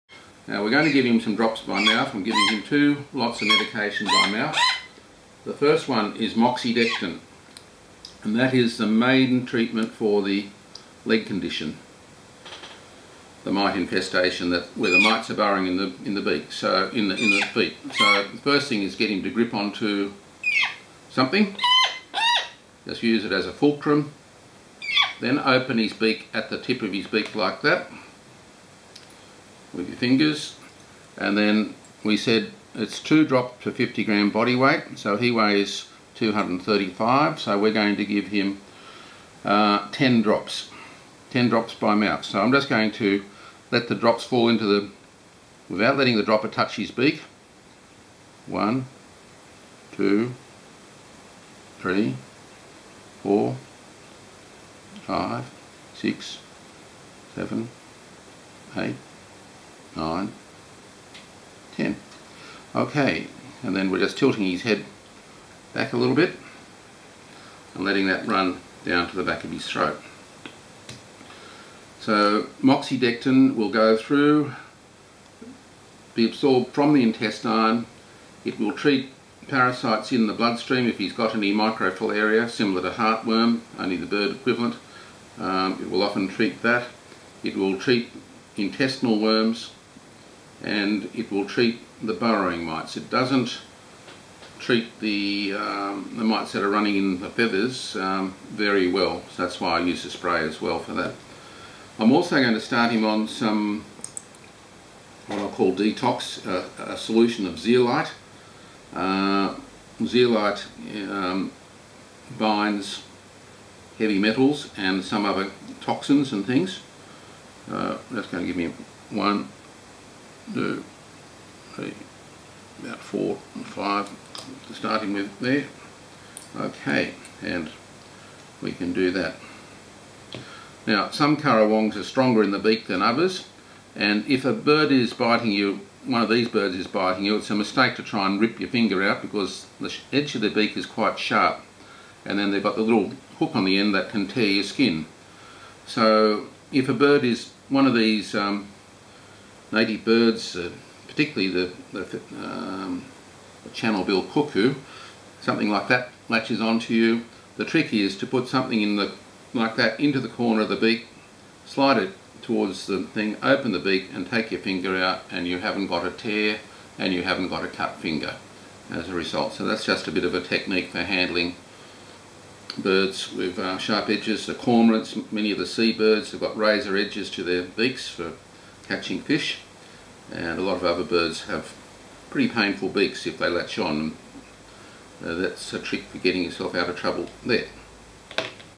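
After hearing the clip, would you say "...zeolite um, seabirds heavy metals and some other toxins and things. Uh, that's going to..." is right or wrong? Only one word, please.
wrong.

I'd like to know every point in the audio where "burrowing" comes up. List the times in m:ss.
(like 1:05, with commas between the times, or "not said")
0:15, 1:32.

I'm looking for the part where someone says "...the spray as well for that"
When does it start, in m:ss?
1:40.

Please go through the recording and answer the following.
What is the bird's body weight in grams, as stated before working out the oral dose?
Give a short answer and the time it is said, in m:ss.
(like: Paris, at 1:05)
235, at 0:36.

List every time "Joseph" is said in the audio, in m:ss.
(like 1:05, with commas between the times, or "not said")
not said.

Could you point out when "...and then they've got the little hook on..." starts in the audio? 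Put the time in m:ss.
2:22.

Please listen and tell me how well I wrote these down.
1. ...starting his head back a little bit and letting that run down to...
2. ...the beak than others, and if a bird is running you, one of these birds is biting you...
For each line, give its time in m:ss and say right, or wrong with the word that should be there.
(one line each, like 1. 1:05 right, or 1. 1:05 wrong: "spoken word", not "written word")
1. 1:04 wrong: "tilting", not "starting"
2. 2:12 wrong: "biting", not "running".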